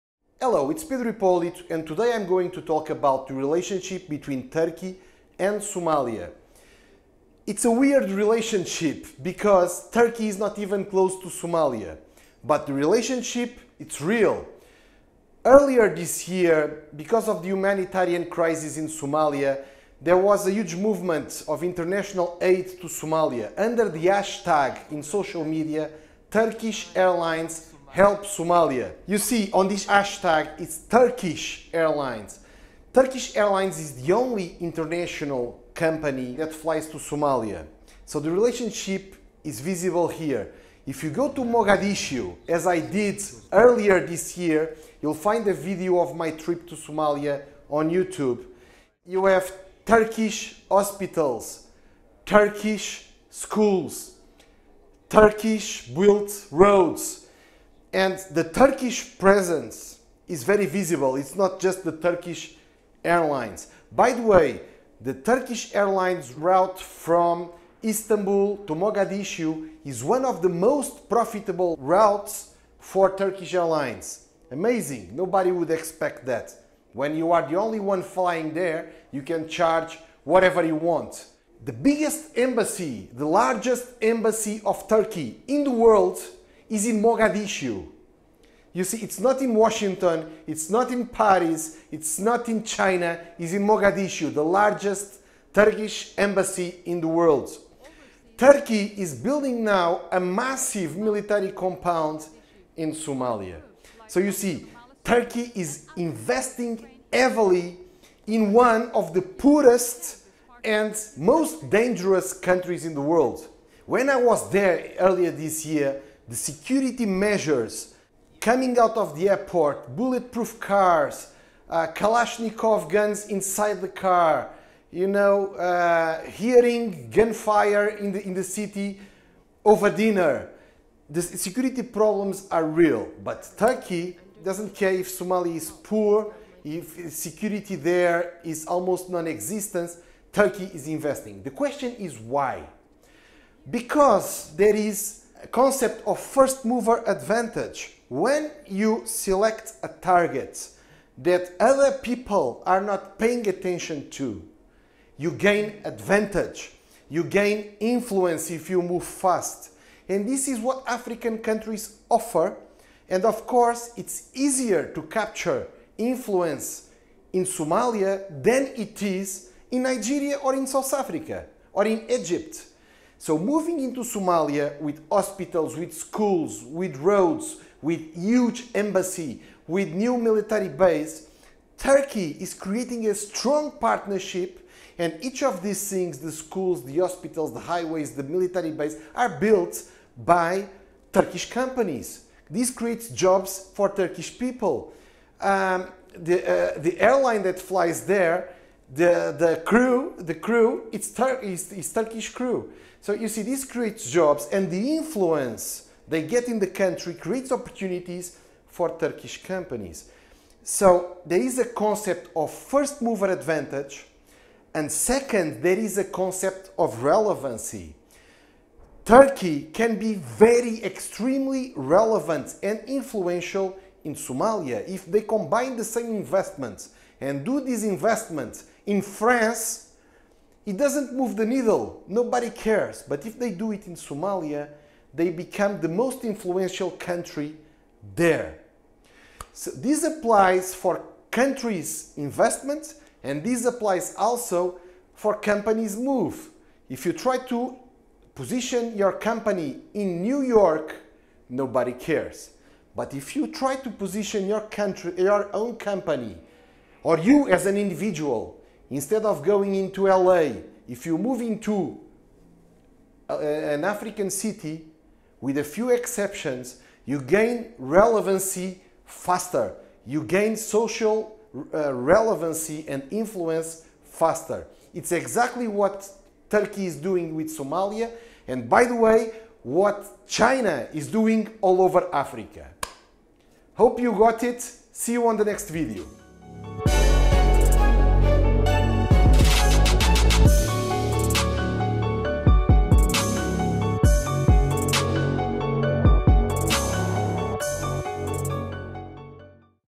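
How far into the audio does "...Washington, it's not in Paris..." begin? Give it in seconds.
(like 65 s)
89 s.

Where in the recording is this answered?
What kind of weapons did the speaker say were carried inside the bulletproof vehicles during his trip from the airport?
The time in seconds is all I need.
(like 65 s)
121 s.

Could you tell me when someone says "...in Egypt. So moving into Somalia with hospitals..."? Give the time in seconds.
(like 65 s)
171 s.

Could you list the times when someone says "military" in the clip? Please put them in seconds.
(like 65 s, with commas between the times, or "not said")
100 s, 180 s, 188 s.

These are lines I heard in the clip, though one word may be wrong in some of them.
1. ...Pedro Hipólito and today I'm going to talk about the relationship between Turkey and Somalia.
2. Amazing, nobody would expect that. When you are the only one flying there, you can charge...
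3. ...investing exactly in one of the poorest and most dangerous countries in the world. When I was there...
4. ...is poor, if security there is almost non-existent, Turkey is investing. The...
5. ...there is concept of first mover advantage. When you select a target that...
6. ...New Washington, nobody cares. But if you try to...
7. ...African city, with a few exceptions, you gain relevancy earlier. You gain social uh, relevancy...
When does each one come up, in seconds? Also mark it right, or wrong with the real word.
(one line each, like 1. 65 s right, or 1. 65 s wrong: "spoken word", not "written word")
1. 0 s right
2. 74 s right
3. 105 s wrong: "heavily", not "exactly"
4. 135 s right
5. 144 s right
6. 250 s wrong: "York", not "Washington"
7. 263 s wrong: "faster", not "earlier".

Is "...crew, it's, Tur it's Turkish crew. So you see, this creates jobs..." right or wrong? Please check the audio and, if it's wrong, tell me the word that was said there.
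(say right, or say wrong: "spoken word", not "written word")
right.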